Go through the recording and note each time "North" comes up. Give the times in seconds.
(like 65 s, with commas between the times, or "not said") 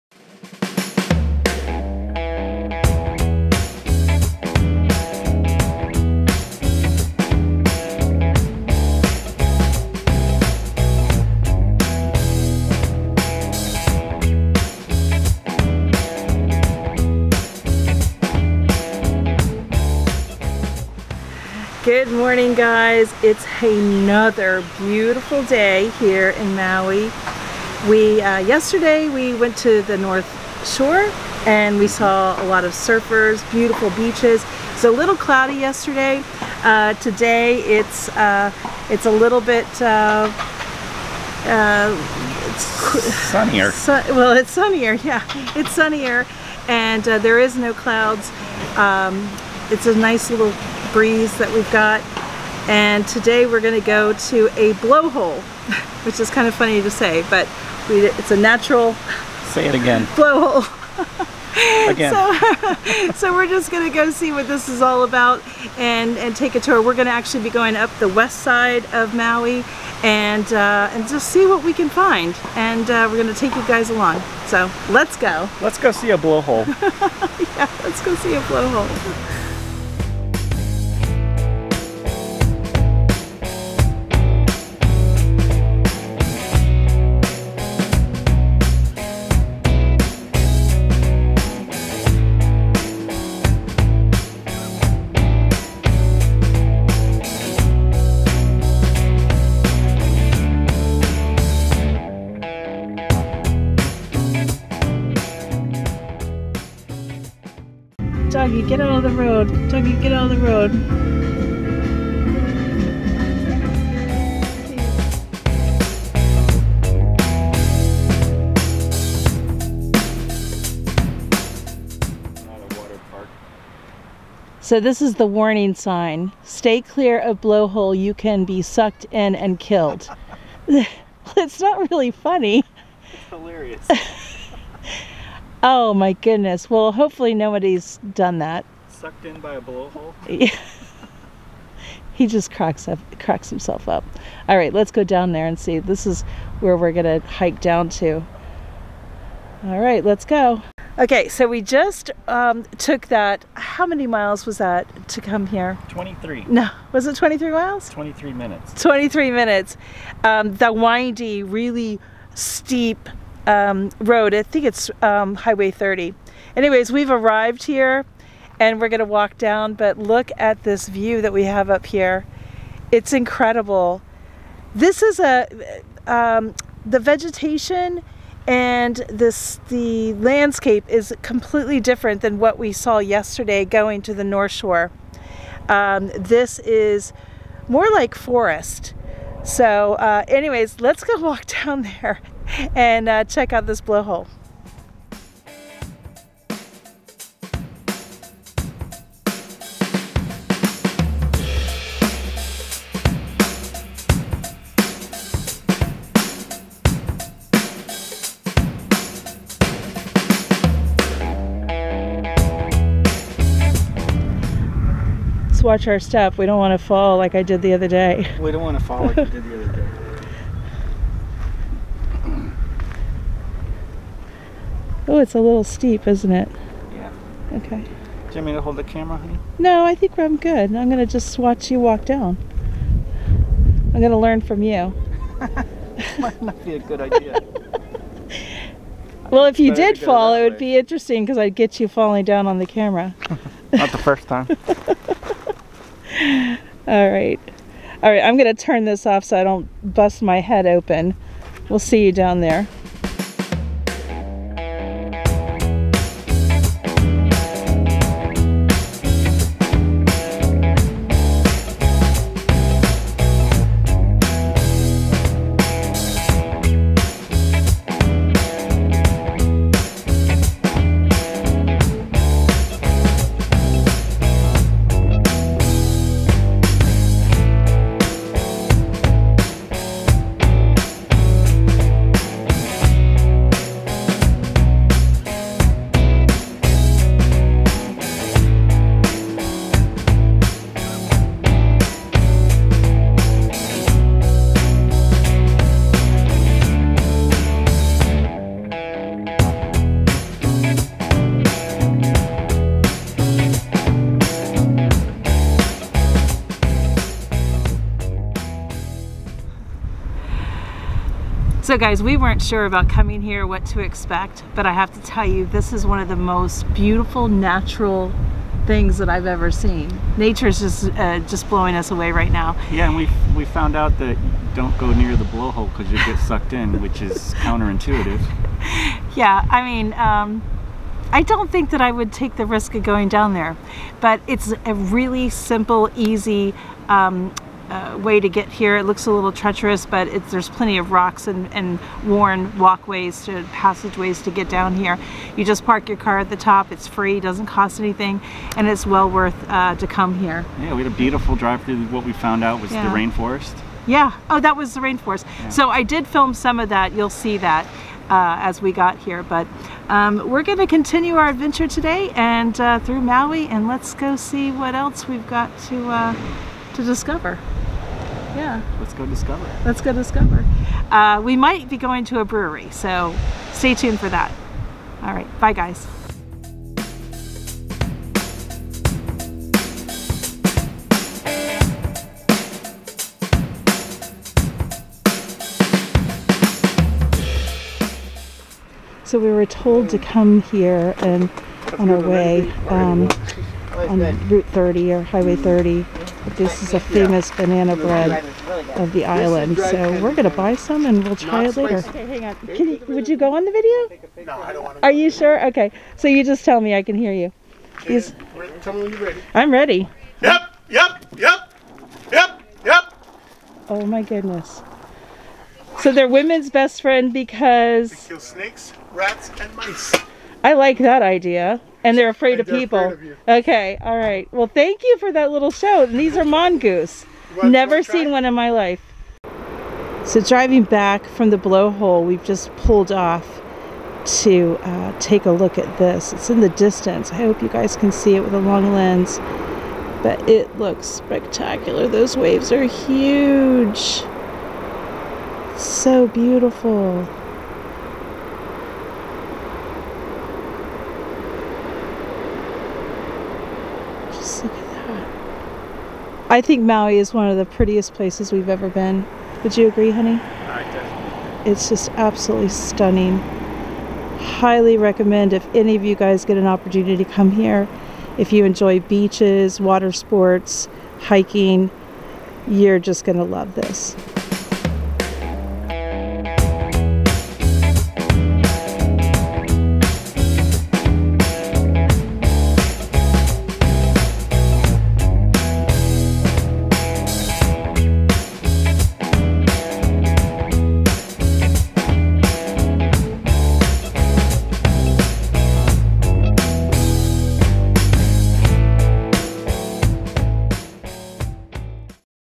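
29 s, 184 s.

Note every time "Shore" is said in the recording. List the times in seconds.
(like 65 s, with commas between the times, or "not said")
30 s, 184 s.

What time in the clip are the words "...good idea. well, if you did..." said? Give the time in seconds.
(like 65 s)
236 s.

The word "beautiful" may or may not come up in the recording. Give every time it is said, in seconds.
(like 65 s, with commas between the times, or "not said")
24 s, 33 s, 316 s, 350 s, 446 s.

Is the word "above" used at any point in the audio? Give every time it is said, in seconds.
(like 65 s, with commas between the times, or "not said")
not said.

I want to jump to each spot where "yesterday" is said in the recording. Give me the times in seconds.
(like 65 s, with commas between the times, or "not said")
28 s, 35 s, 182 s.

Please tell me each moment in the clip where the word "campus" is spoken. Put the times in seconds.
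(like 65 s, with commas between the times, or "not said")
not said.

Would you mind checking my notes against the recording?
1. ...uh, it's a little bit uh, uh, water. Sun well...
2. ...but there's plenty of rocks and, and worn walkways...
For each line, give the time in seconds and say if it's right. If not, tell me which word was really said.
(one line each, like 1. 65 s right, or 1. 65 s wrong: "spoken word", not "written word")
1. 38 s wrong: "sunnier", not "water"
2. 339 s right.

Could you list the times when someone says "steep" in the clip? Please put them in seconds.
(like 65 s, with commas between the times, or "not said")
162 s, 225 s.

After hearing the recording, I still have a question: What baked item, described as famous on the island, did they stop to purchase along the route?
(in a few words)
Banana bread.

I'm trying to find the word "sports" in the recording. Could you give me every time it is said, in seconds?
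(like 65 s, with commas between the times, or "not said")
469 s.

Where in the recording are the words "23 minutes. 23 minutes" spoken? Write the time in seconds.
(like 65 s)
157 s.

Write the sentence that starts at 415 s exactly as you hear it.
So they're women's best friend because...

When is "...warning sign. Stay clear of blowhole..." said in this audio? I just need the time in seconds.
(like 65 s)
125 s.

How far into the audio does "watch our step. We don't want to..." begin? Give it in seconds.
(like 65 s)
215 s.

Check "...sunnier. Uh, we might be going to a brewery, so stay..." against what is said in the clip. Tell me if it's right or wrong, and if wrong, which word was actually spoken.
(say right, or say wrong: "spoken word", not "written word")
wrong: "discover", not "sunnier".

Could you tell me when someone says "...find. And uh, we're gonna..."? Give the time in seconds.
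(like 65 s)
71 s.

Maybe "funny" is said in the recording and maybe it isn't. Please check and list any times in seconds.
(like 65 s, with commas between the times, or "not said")
56 s, 132 s.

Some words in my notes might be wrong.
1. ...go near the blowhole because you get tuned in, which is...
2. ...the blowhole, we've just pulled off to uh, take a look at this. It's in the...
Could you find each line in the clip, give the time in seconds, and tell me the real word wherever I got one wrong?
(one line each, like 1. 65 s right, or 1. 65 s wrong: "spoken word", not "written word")
1. 324 s wrong: "sucked", not "tuned"
2. 431 s right.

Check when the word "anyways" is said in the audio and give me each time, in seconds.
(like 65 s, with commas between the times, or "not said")
166 s, 190 s.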